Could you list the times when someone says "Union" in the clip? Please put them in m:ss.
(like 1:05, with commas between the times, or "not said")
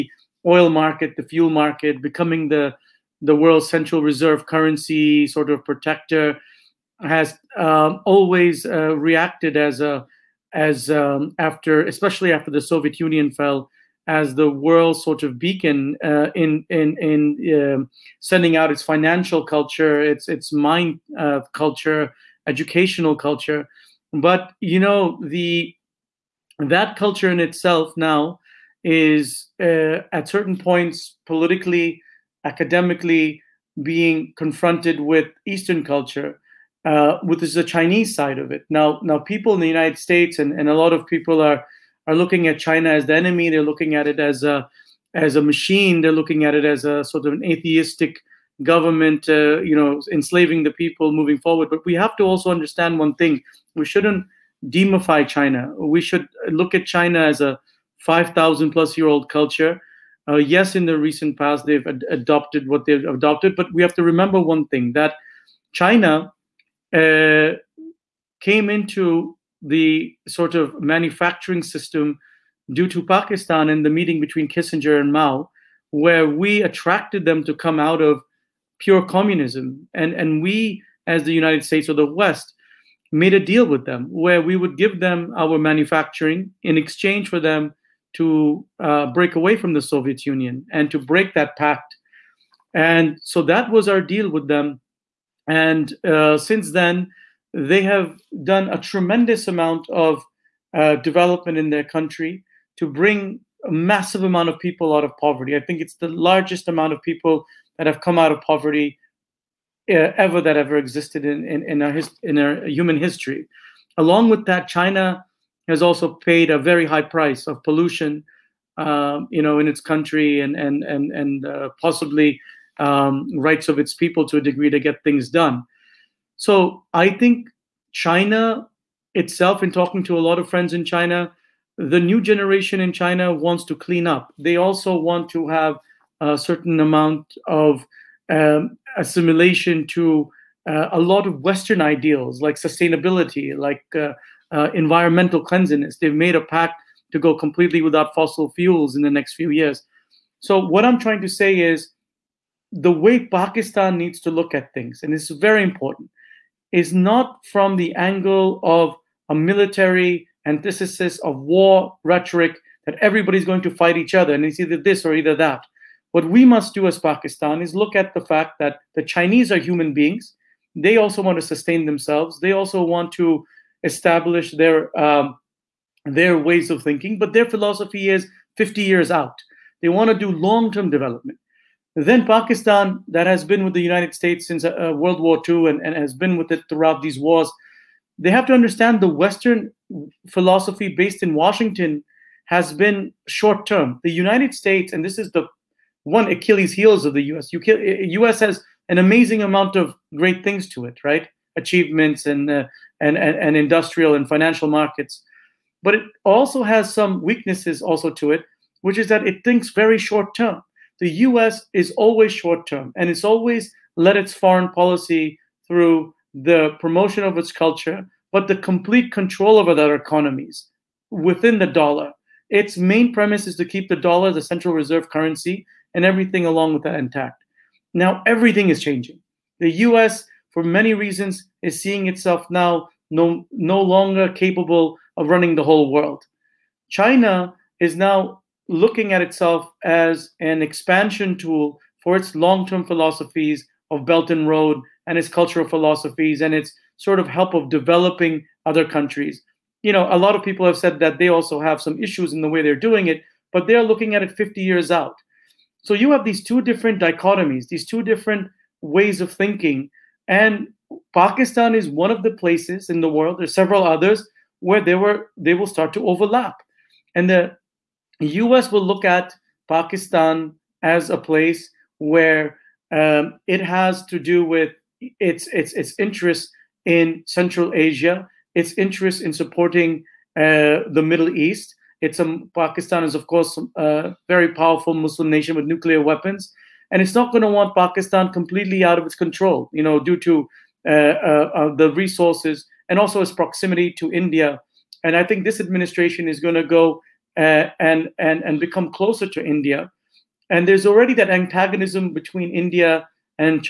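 0:12, 1:30.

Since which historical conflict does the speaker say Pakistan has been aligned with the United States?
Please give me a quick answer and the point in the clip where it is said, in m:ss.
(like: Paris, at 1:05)
World War II, at 3:04.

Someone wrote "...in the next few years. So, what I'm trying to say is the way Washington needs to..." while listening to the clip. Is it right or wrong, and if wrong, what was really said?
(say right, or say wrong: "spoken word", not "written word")
wrong: "Pakistan", not "Washington".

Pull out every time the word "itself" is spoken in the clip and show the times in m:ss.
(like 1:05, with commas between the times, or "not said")
0:27, 2:09, 3:52, 3:59.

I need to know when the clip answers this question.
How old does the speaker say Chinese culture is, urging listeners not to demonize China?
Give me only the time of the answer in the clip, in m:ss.
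0:58.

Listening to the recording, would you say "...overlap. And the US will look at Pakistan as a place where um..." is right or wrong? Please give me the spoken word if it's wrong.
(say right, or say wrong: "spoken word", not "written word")
right.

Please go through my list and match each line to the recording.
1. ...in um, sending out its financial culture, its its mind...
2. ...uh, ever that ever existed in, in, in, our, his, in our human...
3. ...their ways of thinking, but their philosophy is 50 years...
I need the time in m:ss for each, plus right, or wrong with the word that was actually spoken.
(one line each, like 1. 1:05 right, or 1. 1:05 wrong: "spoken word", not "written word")
1. 0:16 right
2. 1:49 right
3. 2:56 right.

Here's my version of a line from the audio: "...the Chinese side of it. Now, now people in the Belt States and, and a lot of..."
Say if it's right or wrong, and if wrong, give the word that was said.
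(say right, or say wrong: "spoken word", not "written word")
wrong: "United", not "Belt".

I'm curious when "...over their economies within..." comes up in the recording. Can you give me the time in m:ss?
3:39.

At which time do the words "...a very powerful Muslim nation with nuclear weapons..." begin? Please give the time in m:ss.
4:43.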